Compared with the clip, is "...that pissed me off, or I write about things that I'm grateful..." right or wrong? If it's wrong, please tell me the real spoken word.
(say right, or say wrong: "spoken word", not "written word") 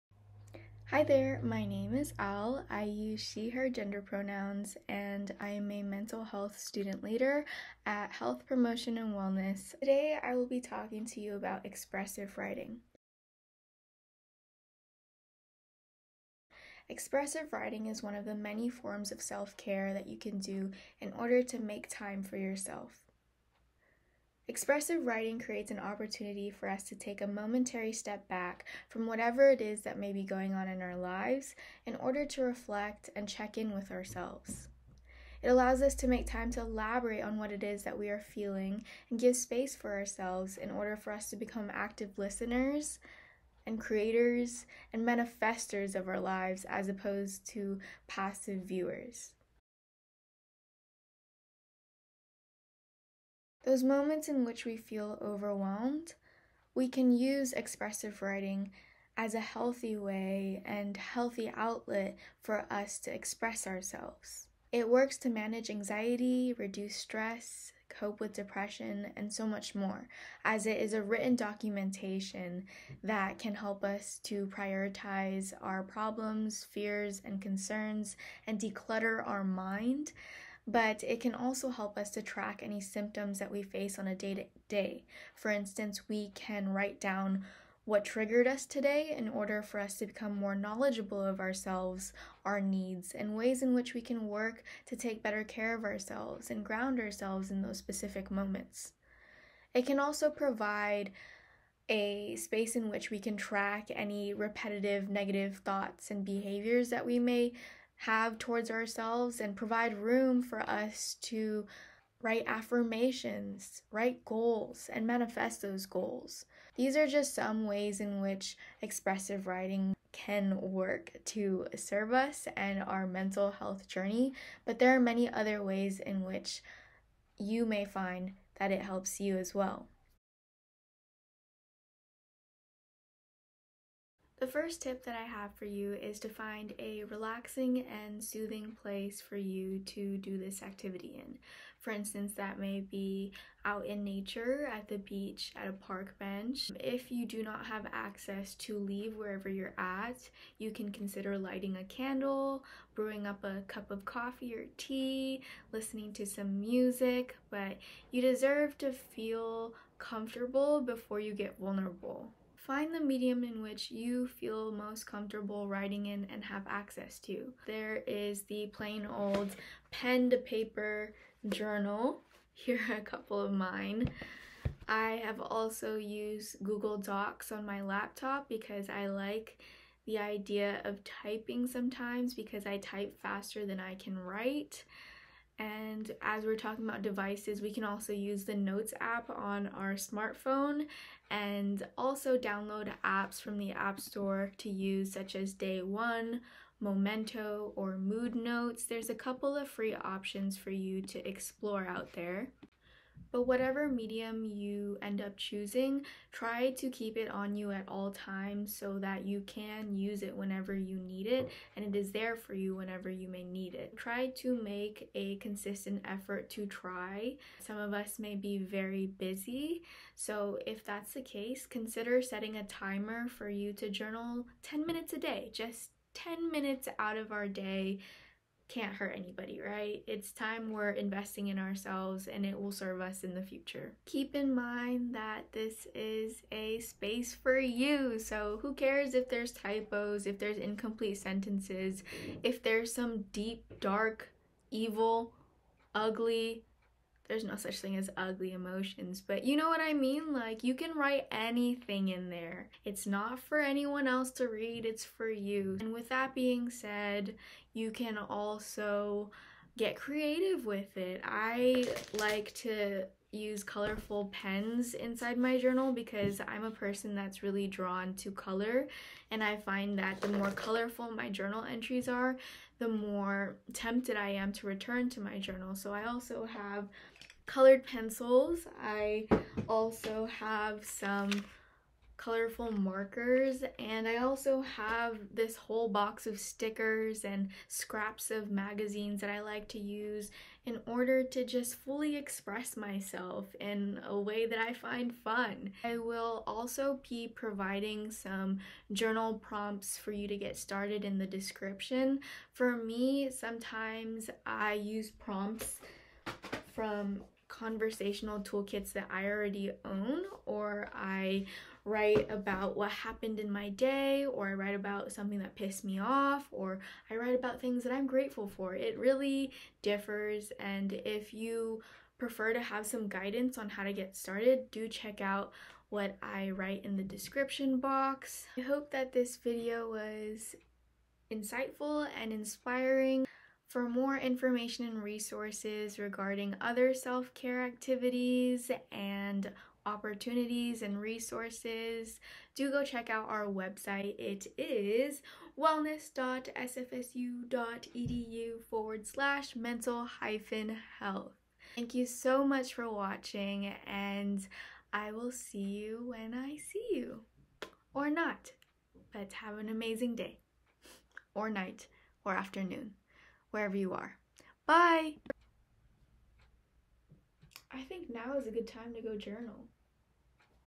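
right.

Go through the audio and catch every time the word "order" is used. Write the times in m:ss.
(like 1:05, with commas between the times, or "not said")
0:21, 0:31, 0:40, 1:29, 4:50.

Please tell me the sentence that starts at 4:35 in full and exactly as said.
So I also have colored pencils.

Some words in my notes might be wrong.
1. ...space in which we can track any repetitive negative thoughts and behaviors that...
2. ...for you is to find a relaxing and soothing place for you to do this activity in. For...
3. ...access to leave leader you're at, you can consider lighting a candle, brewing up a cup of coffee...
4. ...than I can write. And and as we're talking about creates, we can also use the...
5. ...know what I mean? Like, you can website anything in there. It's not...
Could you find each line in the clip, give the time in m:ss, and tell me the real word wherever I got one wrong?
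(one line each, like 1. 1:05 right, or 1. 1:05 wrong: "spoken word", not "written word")
1. 1:42 right
2. 2:15 right
3. 2:27 wrong: "wherever", not "leader"
4. 3:03 wrong: "devices", not "creates"
5. 4:09 wrong: "write", not "website".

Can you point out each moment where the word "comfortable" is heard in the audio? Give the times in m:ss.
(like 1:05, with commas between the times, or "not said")
2:39, 2:45.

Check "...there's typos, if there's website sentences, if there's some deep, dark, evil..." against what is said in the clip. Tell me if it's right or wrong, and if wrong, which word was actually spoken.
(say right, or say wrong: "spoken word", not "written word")
wrong: "incomplete", not "website".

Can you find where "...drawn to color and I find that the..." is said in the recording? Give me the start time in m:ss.
4:27.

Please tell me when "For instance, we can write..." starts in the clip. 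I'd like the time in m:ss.
1:25.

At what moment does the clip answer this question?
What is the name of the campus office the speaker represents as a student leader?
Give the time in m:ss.
0:08.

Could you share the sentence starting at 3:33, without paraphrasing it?
Try to make a consistent effort to try.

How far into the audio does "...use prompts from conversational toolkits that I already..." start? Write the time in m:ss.
5:04.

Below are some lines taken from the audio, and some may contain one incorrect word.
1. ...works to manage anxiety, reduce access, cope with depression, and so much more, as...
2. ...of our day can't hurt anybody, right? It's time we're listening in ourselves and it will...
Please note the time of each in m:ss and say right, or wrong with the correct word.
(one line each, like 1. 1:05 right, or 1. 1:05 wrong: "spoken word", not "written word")
1. 1:04 wrong: "stress", not "access"
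2. 3:47 wrong: "investing", not "listening".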